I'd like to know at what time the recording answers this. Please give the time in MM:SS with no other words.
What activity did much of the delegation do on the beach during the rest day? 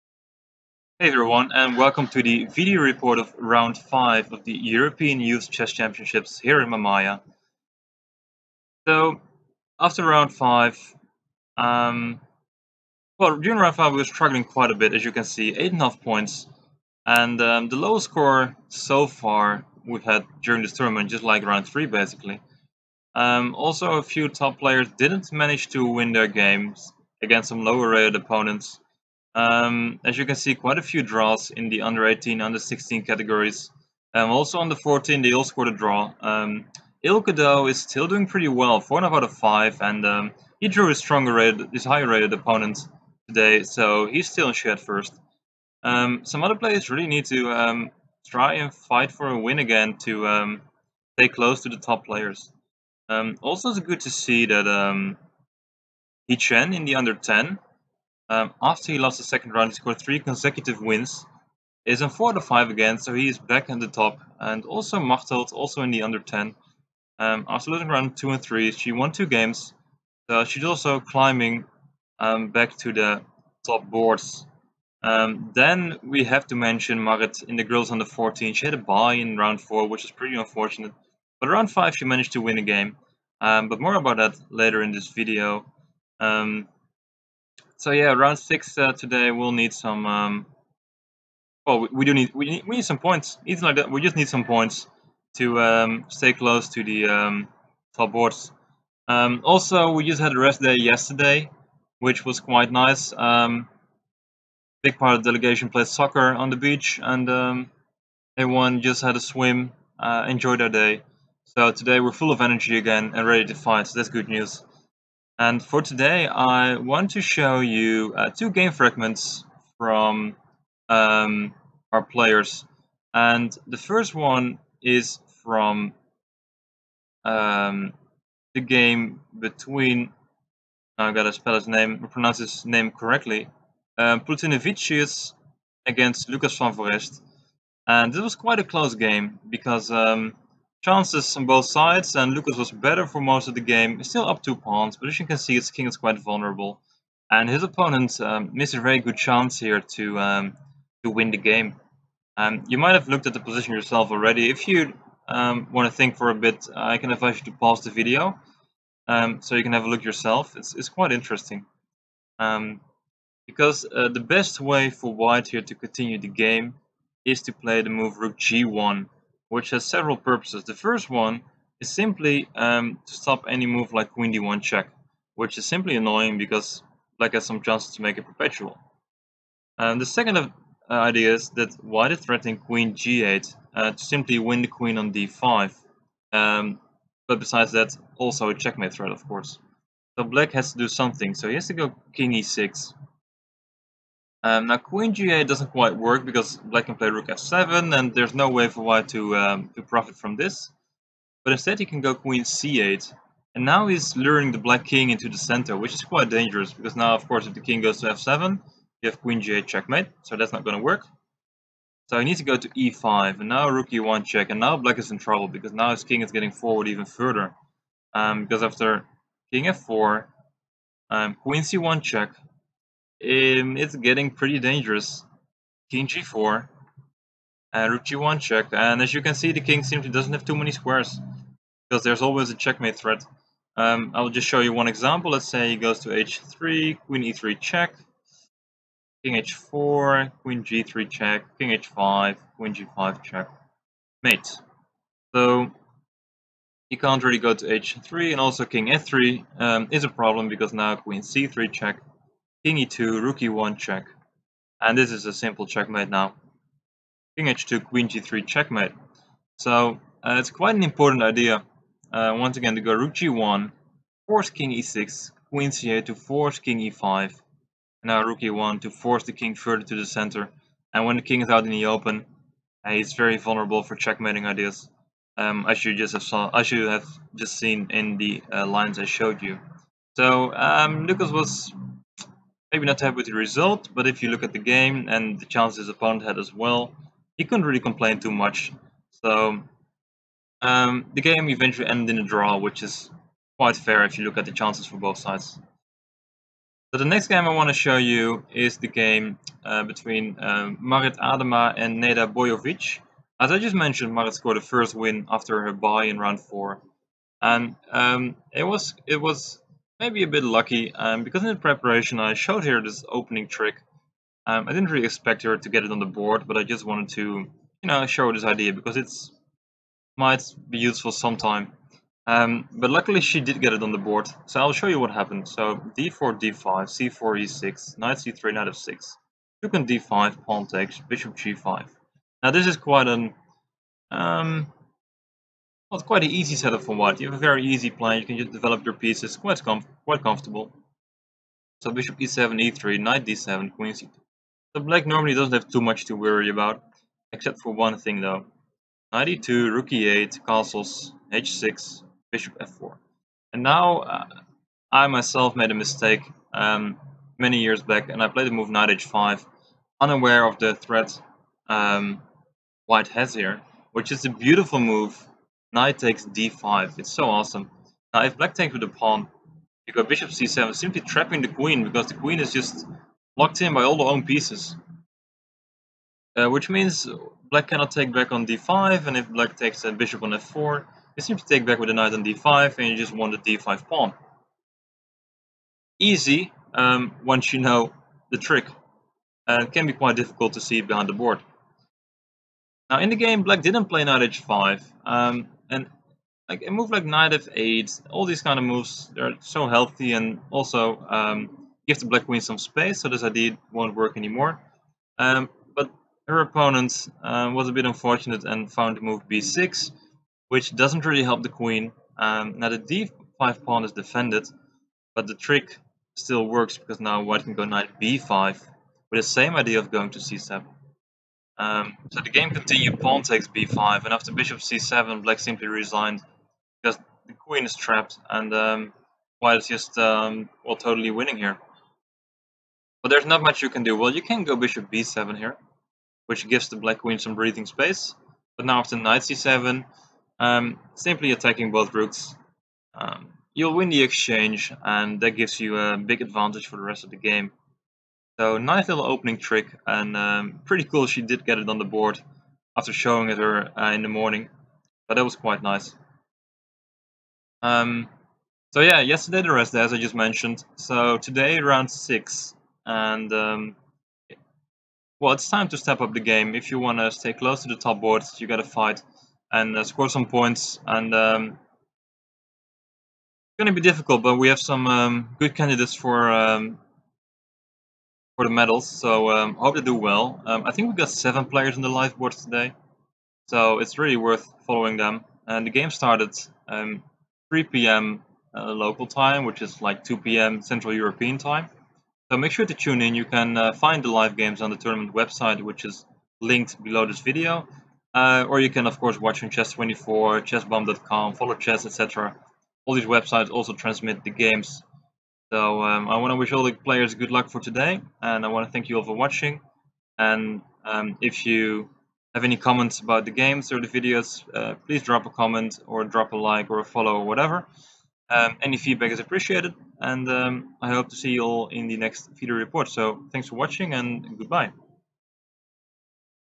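01:45.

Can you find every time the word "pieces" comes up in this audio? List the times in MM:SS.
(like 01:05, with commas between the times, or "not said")
05:38, 06:14.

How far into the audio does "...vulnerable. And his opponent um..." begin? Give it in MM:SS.
02:26.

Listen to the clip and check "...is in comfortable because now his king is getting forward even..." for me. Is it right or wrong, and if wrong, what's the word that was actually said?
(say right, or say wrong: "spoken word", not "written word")
wrong: "trouble", not "comfortable".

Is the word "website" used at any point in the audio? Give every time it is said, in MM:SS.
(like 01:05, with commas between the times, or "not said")
08:15, 08:23.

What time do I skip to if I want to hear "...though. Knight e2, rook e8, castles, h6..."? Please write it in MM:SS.
05:48.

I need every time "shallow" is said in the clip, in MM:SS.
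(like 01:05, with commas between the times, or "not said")
not said.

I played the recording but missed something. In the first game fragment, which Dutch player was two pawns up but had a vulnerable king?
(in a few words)
Lucas van Foreest.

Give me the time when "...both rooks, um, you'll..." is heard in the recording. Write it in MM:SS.
07:21.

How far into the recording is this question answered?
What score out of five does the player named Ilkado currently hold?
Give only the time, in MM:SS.
00:38.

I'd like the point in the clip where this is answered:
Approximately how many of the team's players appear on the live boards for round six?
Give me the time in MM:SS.
08:01.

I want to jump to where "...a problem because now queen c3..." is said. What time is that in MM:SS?
04:10.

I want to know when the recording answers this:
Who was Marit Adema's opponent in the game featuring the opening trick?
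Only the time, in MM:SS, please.
05:02.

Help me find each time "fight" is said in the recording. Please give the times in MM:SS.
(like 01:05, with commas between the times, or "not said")
00:48, 01:53, 07:48.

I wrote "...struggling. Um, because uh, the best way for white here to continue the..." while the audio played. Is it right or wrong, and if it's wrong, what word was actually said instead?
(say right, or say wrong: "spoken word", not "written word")
wrong: "interesting", not "struggling".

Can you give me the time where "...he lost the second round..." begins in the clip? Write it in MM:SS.
00:58.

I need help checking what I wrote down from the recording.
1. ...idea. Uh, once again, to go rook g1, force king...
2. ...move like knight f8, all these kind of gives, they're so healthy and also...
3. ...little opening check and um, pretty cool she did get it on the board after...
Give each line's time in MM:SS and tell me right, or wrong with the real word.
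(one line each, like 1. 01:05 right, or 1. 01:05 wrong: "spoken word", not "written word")
1. 04:21 right
2. 06:36 wrong: "moves", not "gives"
3. 07:28 wrong: "trick", not "check".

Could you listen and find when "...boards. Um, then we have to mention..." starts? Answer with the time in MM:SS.
01:13.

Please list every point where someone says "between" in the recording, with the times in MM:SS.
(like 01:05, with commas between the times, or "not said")
02:09, 04:59.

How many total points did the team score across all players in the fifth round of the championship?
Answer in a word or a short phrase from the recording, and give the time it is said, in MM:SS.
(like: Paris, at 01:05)
8.5, at 00:15.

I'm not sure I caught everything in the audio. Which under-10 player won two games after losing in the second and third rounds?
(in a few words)
Machtelt.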